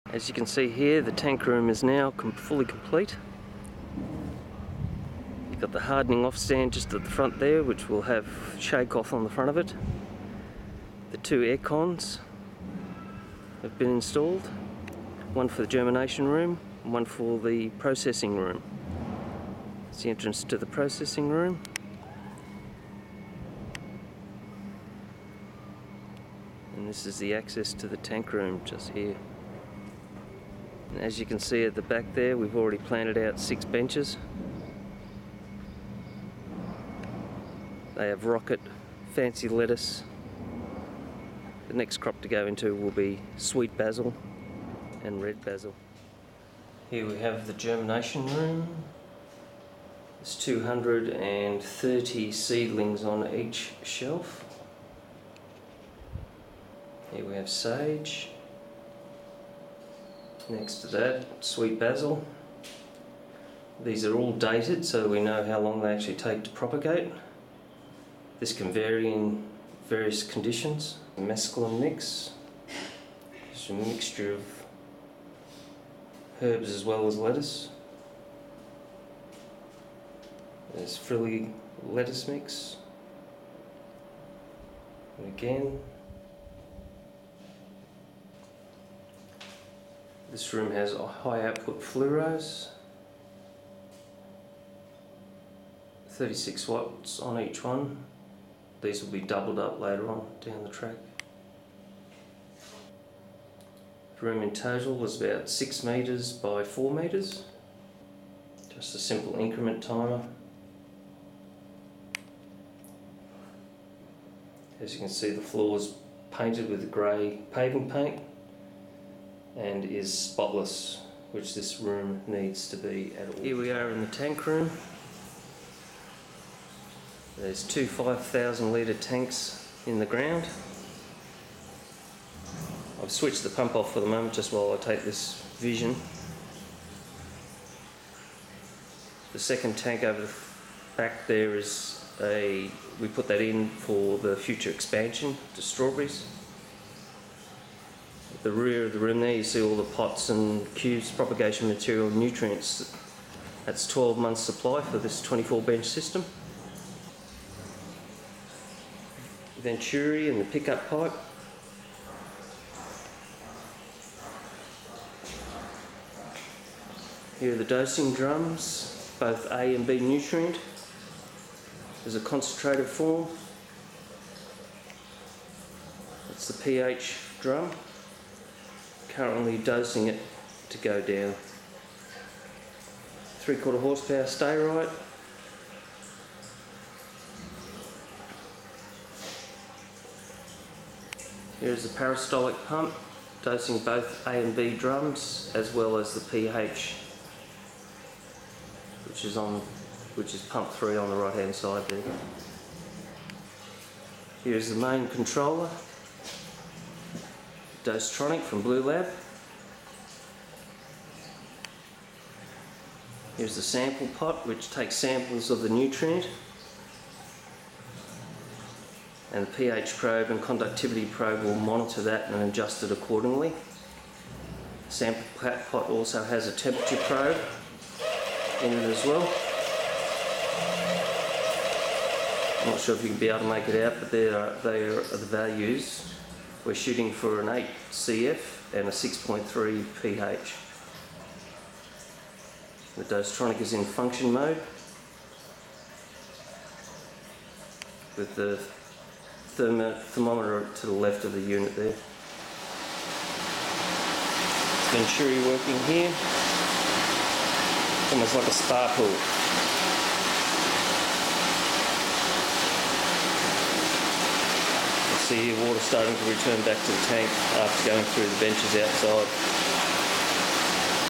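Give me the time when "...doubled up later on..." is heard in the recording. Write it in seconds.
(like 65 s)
99 s.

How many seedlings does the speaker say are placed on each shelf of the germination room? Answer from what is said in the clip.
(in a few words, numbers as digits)
230.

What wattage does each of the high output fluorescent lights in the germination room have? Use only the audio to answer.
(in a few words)
36 watts.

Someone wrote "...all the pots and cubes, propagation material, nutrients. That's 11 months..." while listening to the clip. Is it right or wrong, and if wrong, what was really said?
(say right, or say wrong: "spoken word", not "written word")
wrong: "12", not "11".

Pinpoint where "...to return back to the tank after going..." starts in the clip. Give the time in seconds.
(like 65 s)
266 s.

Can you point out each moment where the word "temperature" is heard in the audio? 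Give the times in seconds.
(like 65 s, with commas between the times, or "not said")
226 s.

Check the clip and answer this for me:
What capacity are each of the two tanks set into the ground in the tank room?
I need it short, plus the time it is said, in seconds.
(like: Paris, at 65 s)
5,000 litres, at 127 s.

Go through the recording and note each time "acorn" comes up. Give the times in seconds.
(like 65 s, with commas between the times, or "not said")
not said.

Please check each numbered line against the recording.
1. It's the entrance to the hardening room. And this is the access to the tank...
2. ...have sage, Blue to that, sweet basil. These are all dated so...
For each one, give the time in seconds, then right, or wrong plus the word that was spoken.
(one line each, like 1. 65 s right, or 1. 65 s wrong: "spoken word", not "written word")
1. 19 s wrong: "processing", not "hardening"
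2. 57 s wrong: "Next", not "Blue".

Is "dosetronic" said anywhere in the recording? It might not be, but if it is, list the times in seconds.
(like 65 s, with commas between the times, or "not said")
207 s, 243 s.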